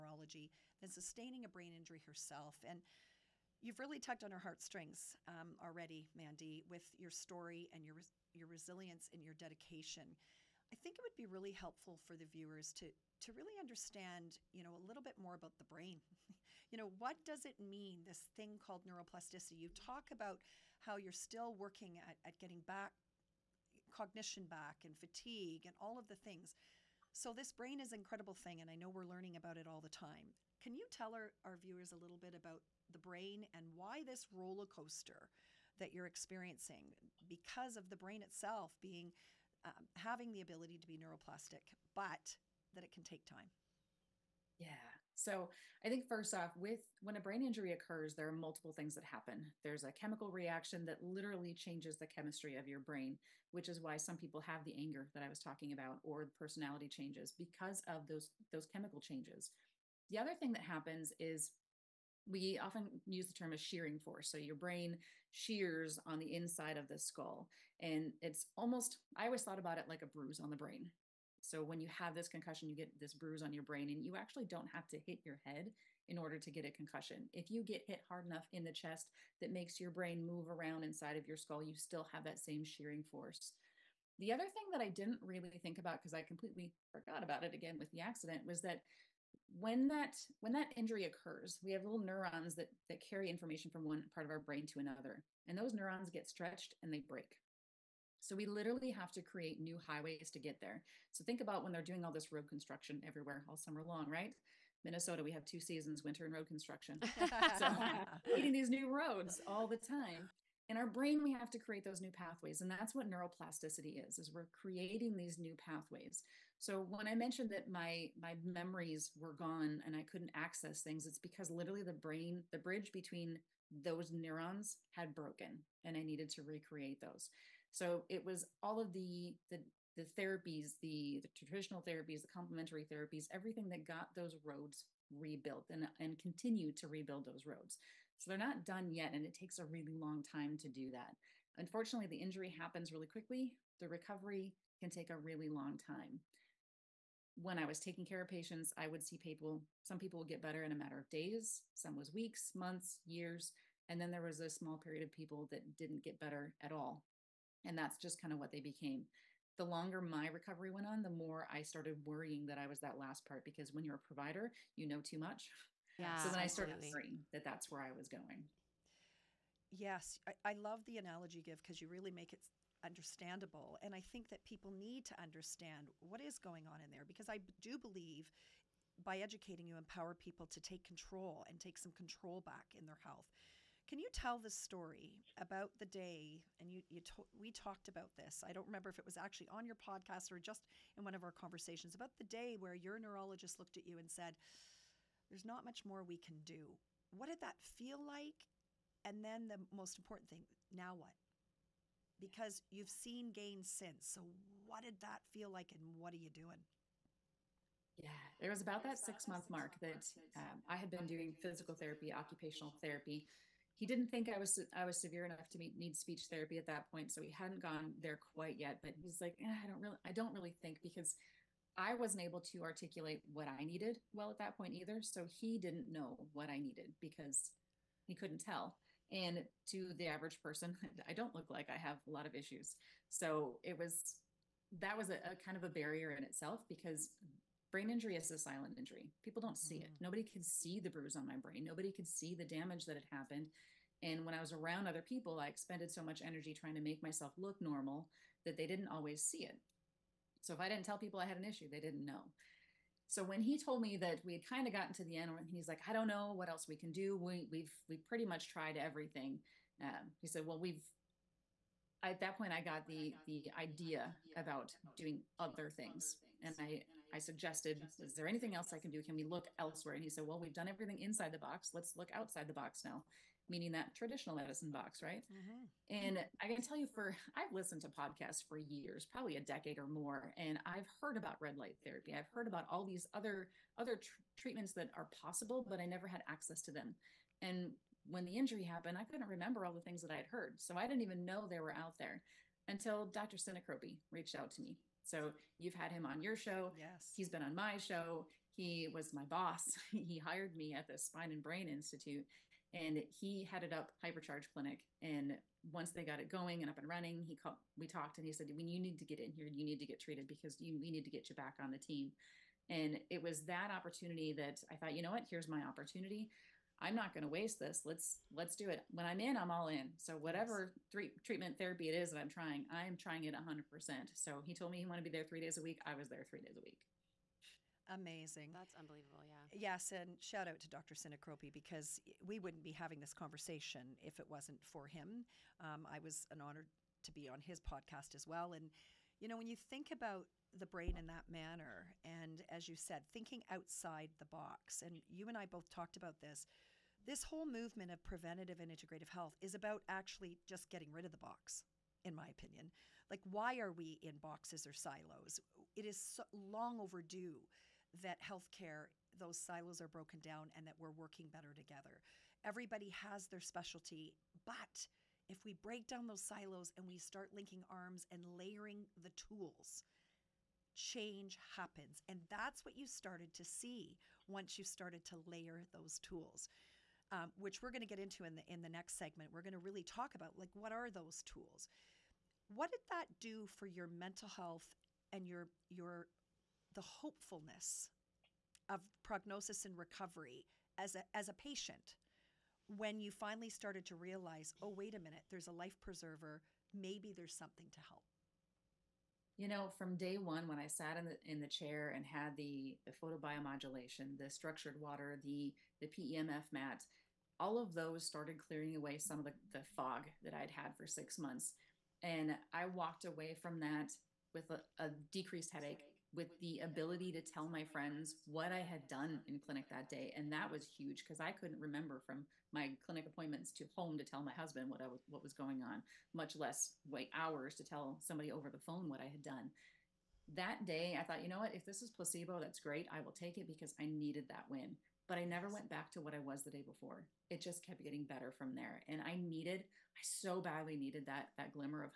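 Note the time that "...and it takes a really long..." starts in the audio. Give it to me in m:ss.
2:19.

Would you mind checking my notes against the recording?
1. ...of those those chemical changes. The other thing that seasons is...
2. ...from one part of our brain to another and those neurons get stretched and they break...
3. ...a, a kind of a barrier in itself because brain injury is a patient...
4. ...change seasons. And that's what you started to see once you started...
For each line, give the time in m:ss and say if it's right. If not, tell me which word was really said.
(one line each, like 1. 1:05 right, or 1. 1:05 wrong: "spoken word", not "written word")
1. 0:57 wrong: "happens", not "seasons"
2. 1:33 right
3. 3:55 wrong: "silent", not "patient"
4. 6:10 wrong: "happens", not "seasons".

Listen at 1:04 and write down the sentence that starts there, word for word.
So your brain shears on the inside of the skull.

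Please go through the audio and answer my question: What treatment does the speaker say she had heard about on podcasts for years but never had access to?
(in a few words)
red light therapy.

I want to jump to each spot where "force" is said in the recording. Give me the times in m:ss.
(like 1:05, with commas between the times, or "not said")
1:03, 1:23.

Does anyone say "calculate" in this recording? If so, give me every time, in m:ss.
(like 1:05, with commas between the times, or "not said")
not said.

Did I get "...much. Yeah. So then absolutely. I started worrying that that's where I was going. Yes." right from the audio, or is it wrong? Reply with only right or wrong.
right.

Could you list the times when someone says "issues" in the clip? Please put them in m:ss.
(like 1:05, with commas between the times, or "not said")
3:52, 4:11.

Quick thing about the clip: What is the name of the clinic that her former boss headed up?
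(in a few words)
Hypercharge Clinic.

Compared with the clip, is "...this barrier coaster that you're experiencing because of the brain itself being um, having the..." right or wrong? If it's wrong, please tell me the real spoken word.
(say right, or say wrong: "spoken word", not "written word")
wrong: "roller", not "barrier".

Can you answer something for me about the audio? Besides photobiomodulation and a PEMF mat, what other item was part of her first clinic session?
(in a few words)
structured water.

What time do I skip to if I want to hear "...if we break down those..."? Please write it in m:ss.
6:05.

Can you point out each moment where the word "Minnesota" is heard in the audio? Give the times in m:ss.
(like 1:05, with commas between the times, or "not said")
1:44.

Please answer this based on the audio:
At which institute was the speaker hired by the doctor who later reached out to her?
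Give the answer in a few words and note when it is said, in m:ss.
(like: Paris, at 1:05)
Spine and Brain Institute, at 5:00.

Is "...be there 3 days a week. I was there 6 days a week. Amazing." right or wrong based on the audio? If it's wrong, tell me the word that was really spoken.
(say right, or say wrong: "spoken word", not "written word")
wrong: "3", not "6".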